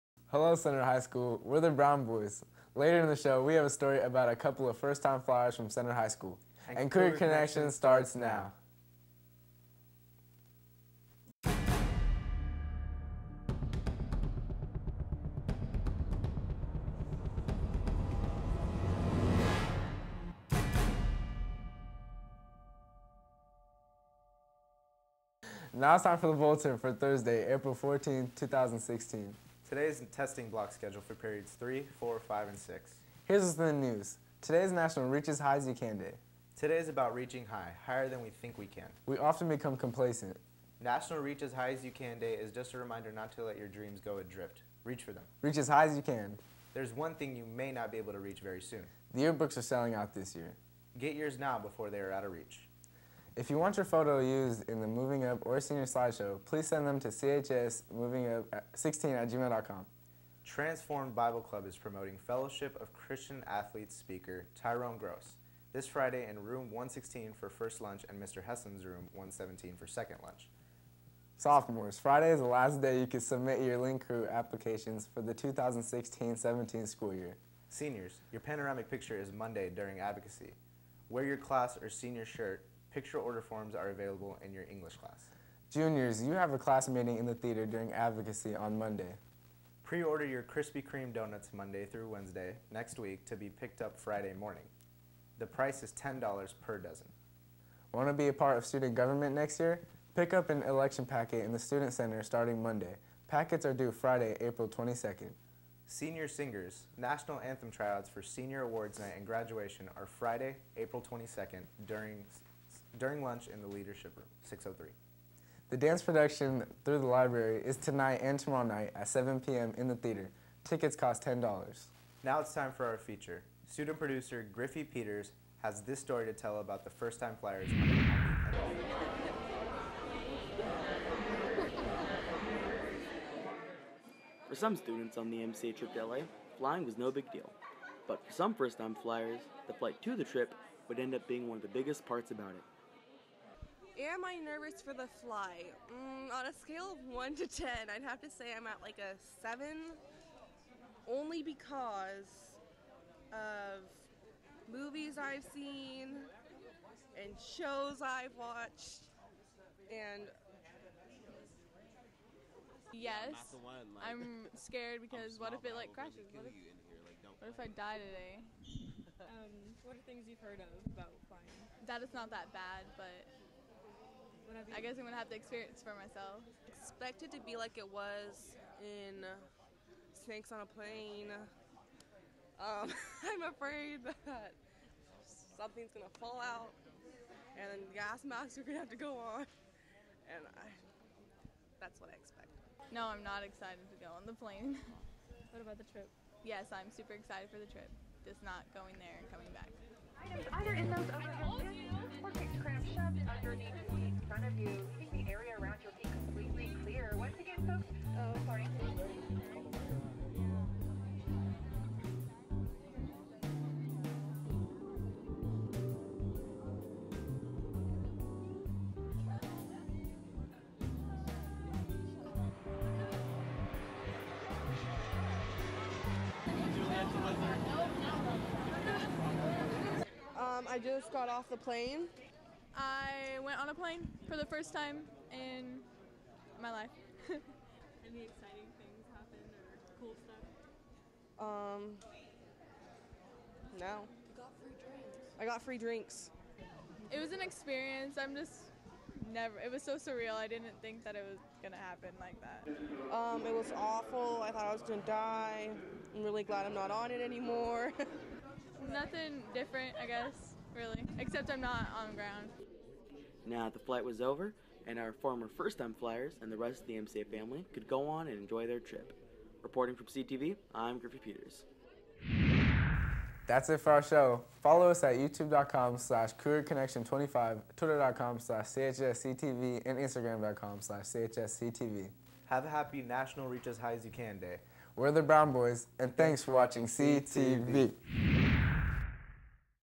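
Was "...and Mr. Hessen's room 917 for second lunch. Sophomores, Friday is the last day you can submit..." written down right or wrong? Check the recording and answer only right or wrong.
wrong.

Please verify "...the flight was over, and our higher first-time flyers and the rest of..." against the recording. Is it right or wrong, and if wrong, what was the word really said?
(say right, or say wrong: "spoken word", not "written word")
wrong: "former", not "higher".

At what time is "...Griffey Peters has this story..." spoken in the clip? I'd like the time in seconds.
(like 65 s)
124 s.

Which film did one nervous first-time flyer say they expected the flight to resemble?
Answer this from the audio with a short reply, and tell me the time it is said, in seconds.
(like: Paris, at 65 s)
Snakes on a Plane, at 180 s.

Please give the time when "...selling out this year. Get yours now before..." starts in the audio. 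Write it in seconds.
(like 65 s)
49 s.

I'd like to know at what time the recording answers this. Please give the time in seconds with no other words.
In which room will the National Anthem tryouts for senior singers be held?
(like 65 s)
114 s.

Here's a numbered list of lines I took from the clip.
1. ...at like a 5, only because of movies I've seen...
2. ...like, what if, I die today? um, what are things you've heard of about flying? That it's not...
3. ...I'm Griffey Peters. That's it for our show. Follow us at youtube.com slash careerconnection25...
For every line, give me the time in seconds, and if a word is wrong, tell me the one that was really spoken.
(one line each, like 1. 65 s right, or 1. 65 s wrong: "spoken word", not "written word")
1. 148 s wrong: "7", not "5"
2. 167 s right
3. 270 s right.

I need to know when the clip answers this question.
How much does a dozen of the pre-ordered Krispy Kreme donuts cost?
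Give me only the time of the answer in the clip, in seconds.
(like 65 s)
95 s.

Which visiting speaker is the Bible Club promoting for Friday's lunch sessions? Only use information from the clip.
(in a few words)
Tyrone Gross.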